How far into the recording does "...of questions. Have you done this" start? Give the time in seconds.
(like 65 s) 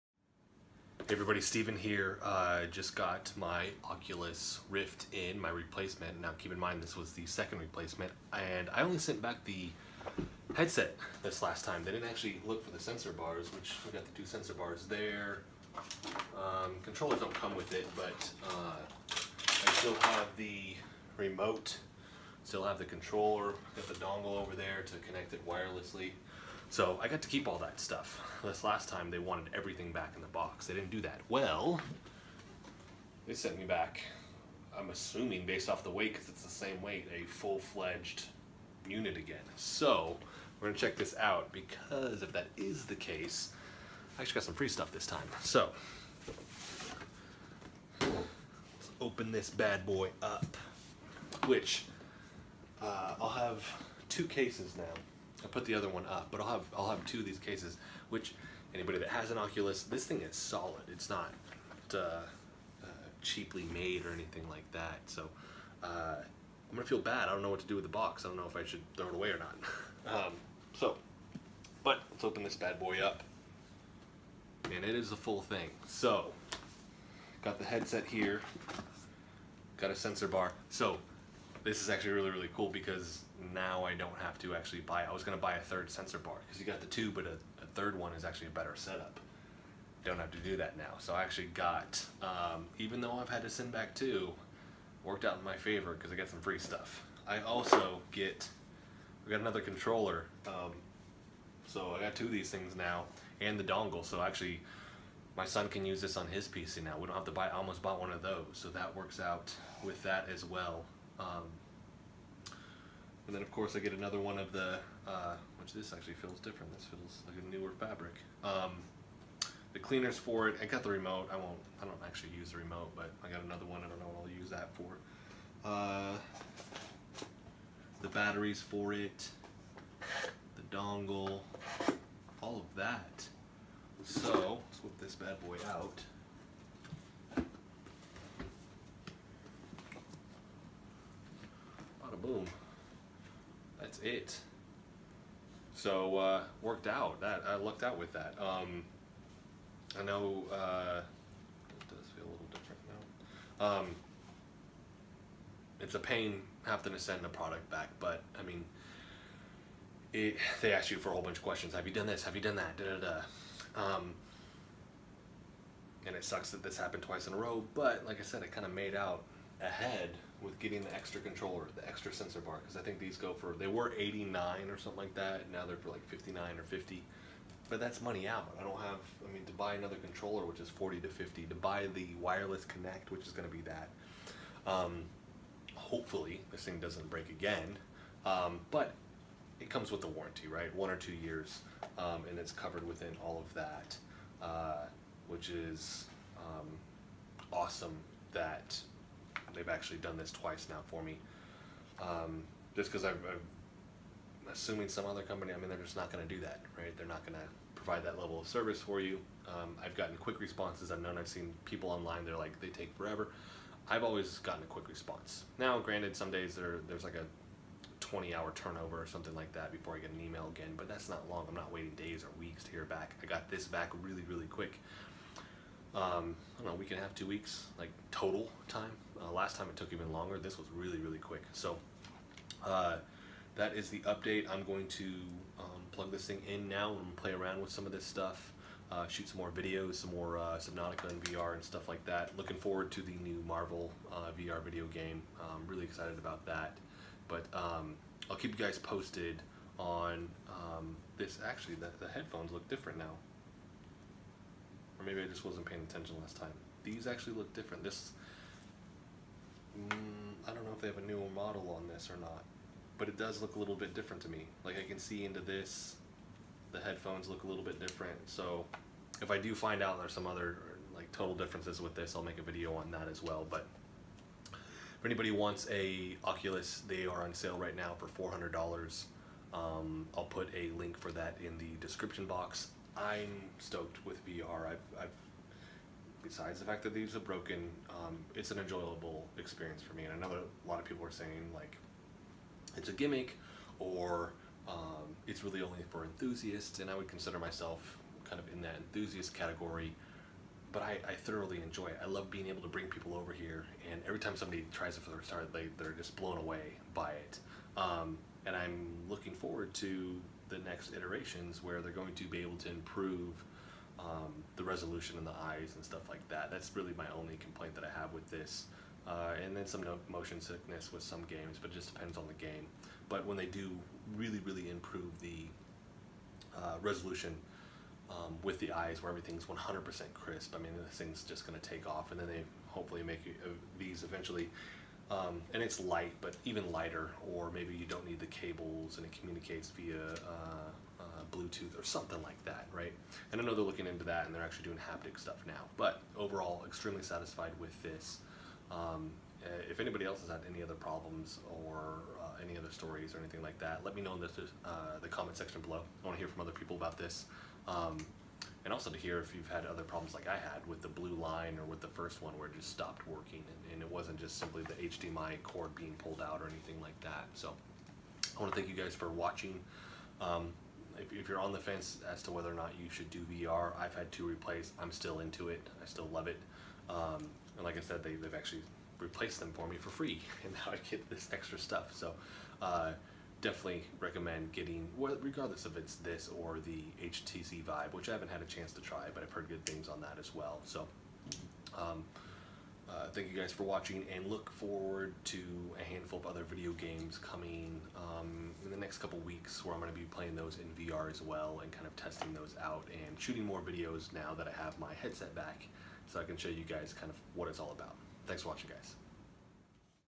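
161 s.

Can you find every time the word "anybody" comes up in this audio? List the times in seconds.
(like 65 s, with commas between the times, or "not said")
58 s, 275 s, 349 s.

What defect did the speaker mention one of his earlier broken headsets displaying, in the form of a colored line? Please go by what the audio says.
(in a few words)
blue line.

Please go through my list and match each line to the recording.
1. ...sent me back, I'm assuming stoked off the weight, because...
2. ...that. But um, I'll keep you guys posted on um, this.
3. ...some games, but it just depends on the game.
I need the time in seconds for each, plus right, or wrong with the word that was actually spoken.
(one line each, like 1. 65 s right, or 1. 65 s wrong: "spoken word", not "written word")
1. 33 s wrong: "based", not "stoked"
2. 246 s right
3. 321 s right.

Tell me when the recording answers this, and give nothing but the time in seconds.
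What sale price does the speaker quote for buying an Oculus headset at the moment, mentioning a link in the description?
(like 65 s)
278 s.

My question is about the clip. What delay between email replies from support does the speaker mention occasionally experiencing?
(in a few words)
20 hours.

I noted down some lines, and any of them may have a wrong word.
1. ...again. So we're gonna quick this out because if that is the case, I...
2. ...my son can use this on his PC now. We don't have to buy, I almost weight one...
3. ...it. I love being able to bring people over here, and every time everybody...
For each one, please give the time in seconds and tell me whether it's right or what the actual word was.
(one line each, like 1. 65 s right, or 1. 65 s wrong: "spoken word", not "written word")
1. 39 s wrong: "check", not "quick"
2. 105 s wrong: "bought", not "weight"
3. 301 s wrong: "somebody", not "everybody".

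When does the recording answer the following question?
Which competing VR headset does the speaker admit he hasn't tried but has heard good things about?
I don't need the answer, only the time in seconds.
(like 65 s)
387 s.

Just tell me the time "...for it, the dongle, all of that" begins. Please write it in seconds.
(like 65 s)
128 s.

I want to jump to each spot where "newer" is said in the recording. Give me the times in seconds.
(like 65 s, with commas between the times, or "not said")
117 s, 261 s.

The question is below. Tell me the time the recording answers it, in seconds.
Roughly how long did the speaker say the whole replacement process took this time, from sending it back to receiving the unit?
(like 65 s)
226 s.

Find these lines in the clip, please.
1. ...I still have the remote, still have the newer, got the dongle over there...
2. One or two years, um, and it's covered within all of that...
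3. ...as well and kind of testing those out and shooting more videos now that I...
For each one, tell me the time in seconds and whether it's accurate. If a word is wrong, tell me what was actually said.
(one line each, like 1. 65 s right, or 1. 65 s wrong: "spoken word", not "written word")
1. 19 s wrong: "controller", not "newer"
2. 190 s right
3. 401 s right.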